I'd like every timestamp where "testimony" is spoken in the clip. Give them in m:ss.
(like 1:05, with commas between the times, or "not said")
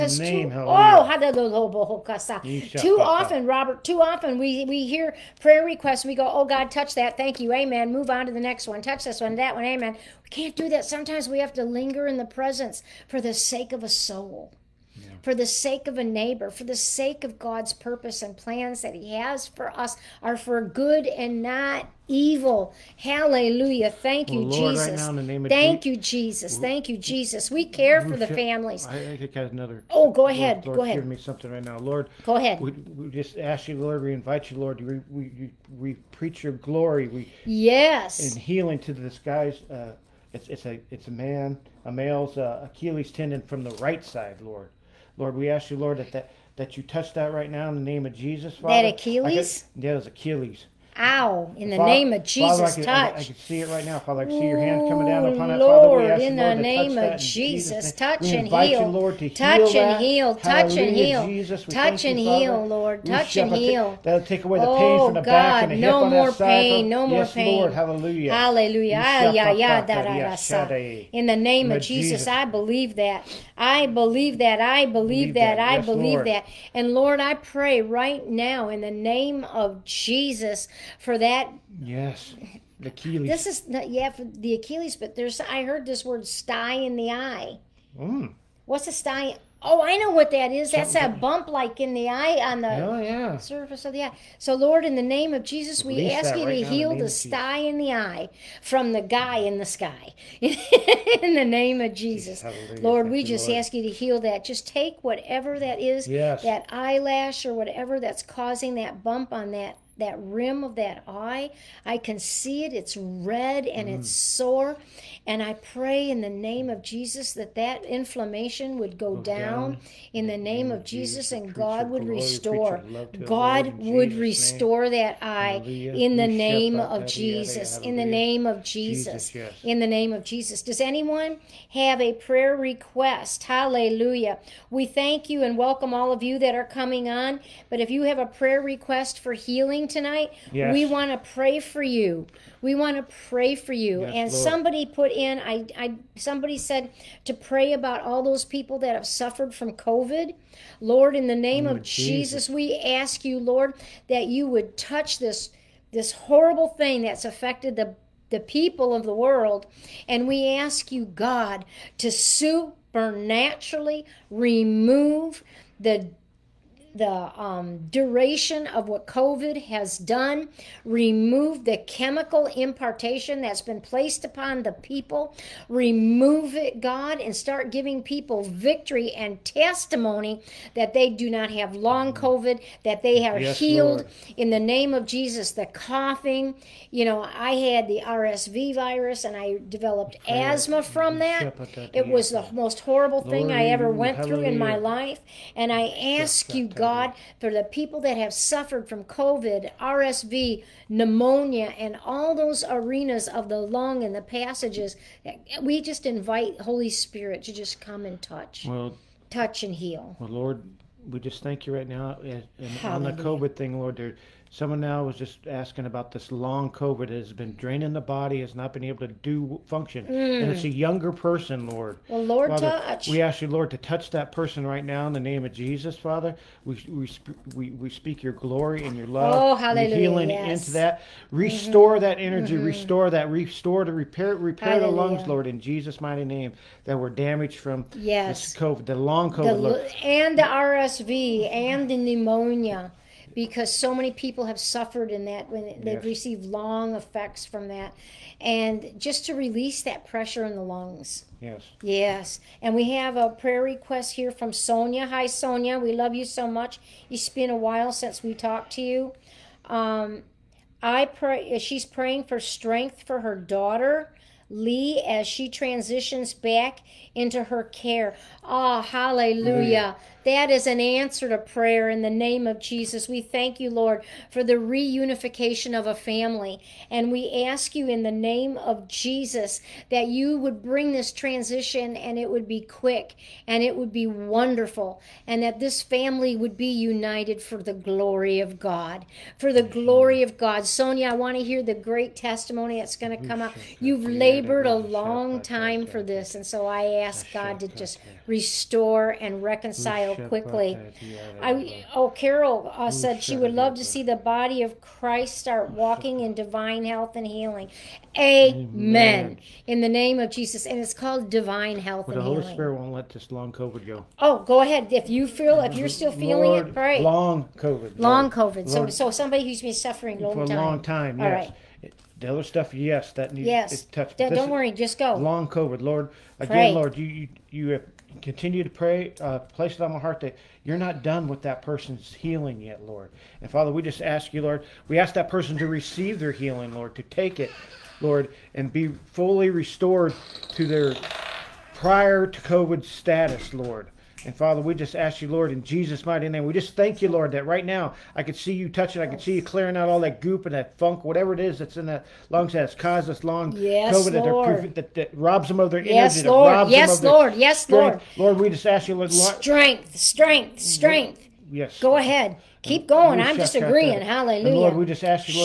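2:59, 4:52.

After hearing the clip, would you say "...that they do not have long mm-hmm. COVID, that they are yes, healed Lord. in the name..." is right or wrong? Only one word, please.
right.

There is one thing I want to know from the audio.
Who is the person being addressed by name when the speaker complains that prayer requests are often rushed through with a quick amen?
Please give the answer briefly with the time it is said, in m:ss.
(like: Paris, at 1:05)
Robert, at 0:03.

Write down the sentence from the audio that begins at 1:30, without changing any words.
That's that bump like in the eye on the oh, yeah.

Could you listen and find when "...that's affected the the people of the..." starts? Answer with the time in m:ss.
2:37.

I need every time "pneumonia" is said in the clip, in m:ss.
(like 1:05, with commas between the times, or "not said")
3:20, 4:01.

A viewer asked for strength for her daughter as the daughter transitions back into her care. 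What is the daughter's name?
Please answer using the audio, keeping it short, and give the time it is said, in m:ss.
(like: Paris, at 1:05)
Lee, at 4:24.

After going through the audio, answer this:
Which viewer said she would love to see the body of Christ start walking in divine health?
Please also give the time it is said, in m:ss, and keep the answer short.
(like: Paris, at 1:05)
Carol, at 5:02.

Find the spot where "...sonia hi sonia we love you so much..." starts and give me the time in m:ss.
4:14.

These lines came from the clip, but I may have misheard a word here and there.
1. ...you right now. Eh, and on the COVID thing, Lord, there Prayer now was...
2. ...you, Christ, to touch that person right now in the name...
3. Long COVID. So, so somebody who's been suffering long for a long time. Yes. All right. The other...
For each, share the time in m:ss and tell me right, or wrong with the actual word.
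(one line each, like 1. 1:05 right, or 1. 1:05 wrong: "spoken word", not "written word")
1. 3:31 wrong: "Someone", not "Prayer"
2. 3:43 wrong: "Lord", not "Christ"
3. 5:17 right.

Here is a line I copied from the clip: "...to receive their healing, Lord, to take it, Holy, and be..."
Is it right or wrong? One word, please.
wrong.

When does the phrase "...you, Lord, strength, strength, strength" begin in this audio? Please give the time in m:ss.
5:58.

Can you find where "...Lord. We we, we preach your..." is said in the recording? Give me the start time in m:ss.
0:34.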